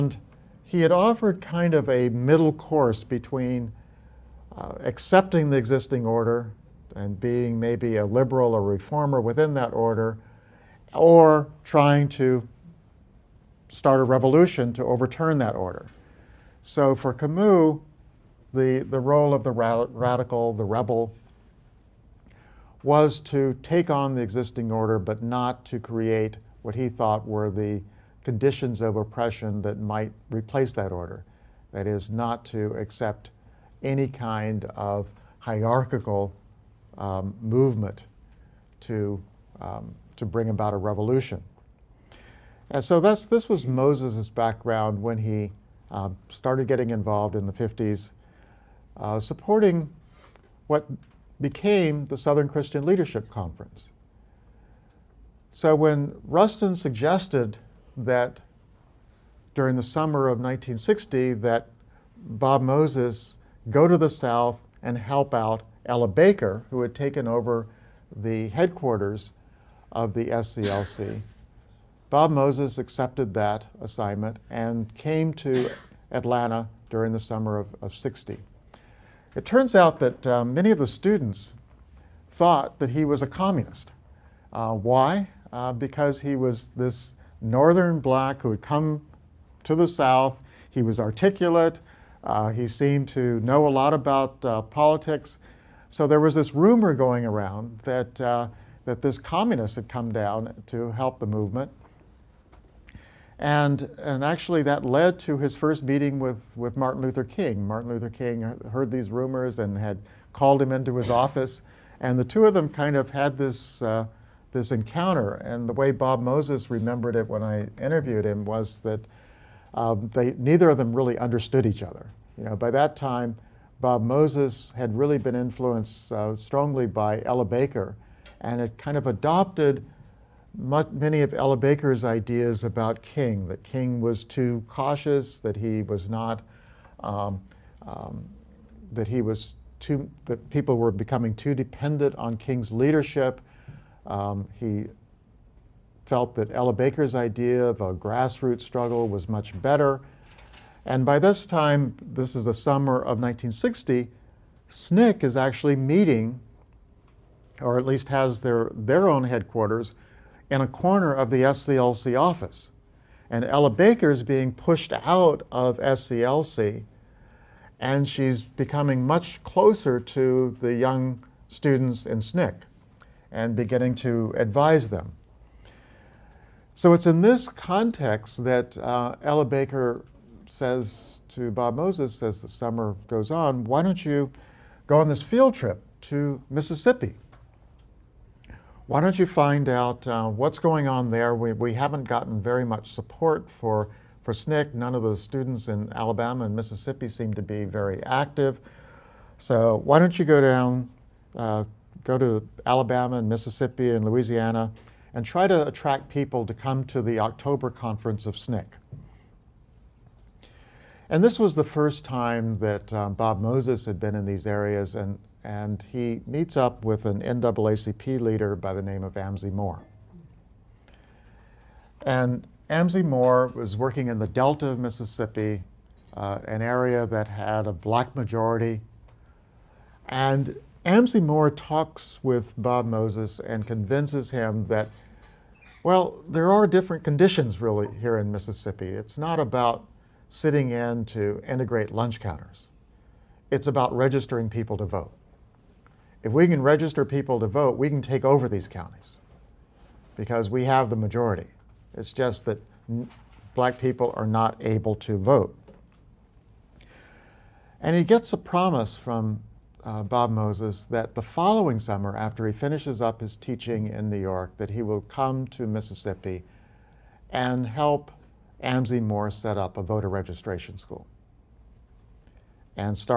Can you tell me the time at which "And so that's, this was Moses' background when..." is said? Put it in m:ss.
0:42.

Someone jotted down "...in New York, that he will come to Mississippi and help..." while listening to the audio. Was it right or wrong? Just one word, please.
right.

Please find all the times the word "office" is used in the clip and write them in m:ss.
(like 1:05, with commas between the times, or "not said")
1:51, 2:42.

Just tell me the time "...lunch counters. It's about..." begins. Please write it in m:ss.
4:01.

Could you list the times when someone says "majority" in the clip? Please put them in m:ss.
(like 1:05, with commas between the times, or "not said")
3:48, 4:10.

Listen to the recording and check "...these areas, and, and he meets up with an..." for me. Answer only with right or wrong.
right.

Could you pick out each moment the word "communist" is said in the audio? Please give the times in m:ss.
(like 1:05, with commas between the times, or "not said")
1:23, 1:39.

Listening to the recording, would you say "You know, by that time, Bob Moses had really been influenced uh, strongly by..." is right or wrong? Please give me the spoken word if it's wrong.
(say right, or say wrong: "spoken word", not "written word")
right.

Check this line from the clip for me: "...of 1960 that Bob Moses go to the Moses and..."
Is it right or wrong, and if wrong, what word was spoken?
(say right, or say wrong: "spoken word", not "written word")
wrong: "South", not "Moses".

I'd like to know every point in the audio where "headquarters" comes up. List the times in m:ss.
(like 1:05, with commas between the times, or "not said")
1:08, 2:39.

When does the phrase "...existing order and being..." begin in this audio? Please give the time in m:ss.
0:05.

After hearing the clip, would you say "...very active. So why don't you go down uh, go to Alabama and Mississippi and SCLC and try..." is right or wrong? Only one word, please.
wrong.